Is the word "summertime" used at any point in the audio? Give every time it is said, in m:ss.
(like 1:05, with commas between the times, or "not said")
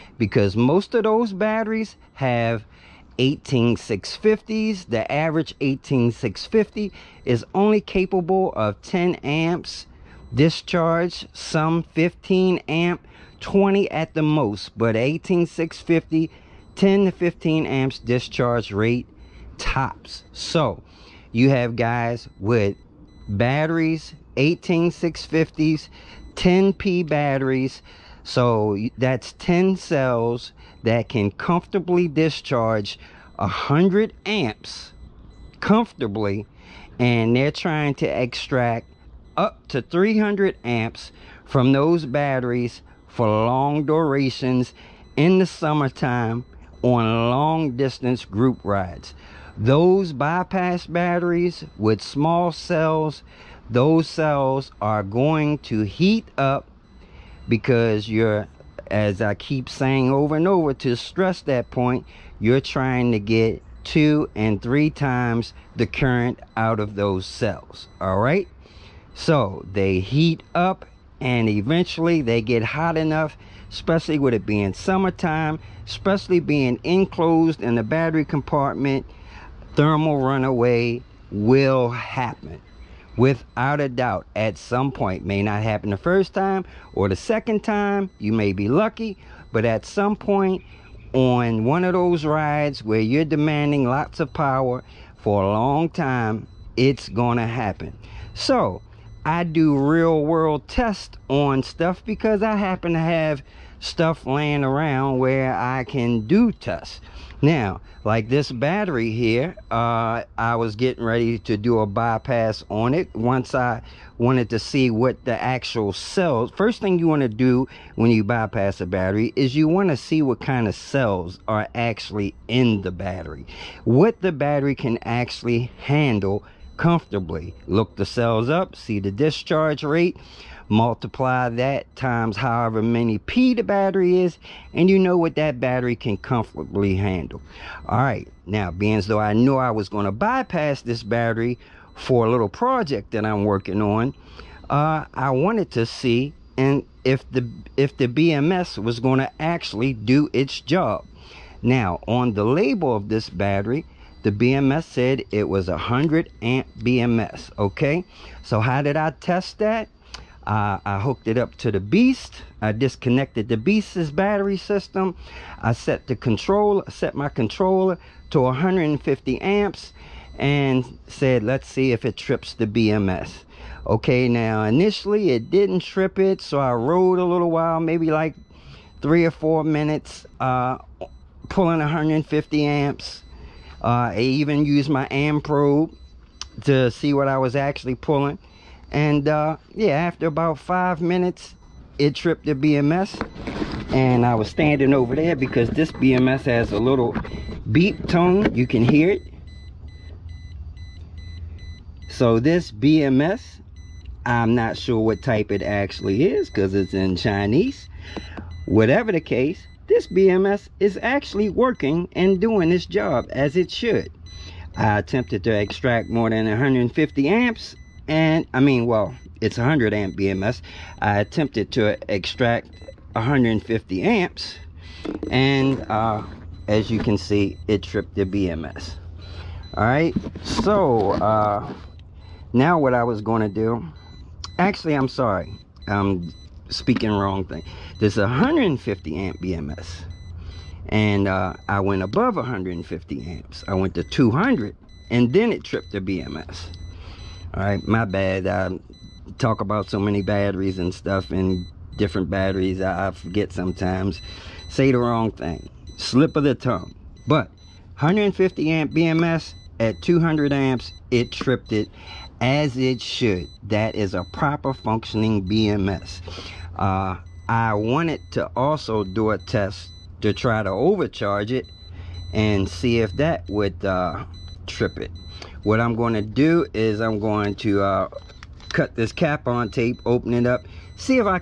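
0:45, 1:14.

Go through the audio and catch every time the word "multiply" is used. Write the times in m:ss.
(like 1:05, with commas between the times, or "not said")
2:10.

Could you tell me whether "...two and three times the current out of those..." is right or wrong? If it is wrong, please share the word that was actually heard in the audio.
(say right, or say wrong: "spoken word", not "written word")
right.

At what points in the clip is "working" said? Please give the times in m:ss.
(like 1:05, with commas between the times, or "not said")
2:23, 3:31.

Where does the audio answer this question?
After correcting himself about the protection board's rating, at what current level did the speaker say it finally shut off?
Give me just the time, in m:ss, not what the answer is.
4:20.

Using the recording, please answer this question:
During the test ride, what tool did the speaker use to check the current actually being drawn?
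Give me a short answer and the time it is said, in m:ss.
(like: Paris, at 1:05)
amp probe, at 3:05.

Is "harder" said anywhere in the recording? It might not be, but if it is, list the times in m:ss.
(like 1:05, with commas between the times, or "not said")
not said.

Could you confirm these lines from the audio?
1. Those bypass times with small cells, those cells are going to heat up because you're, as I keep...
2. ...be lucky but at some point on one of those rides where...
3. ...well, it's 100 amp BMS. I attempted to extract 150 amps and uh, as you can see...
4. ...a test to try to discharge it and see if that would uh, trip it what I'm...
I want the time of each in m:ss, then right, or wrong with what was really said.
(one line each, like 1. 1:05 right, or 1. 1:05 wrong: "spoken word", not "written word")
1. 0:49 wrong: "batteries", not "times"
2. 1:28 right
3. 3:38 right
4. 4:29 wrong: "overcharge", not "discharge".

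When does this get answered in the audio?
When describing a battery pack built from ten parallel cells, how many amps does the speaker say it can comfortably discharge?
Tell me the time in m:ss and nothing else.
0:33.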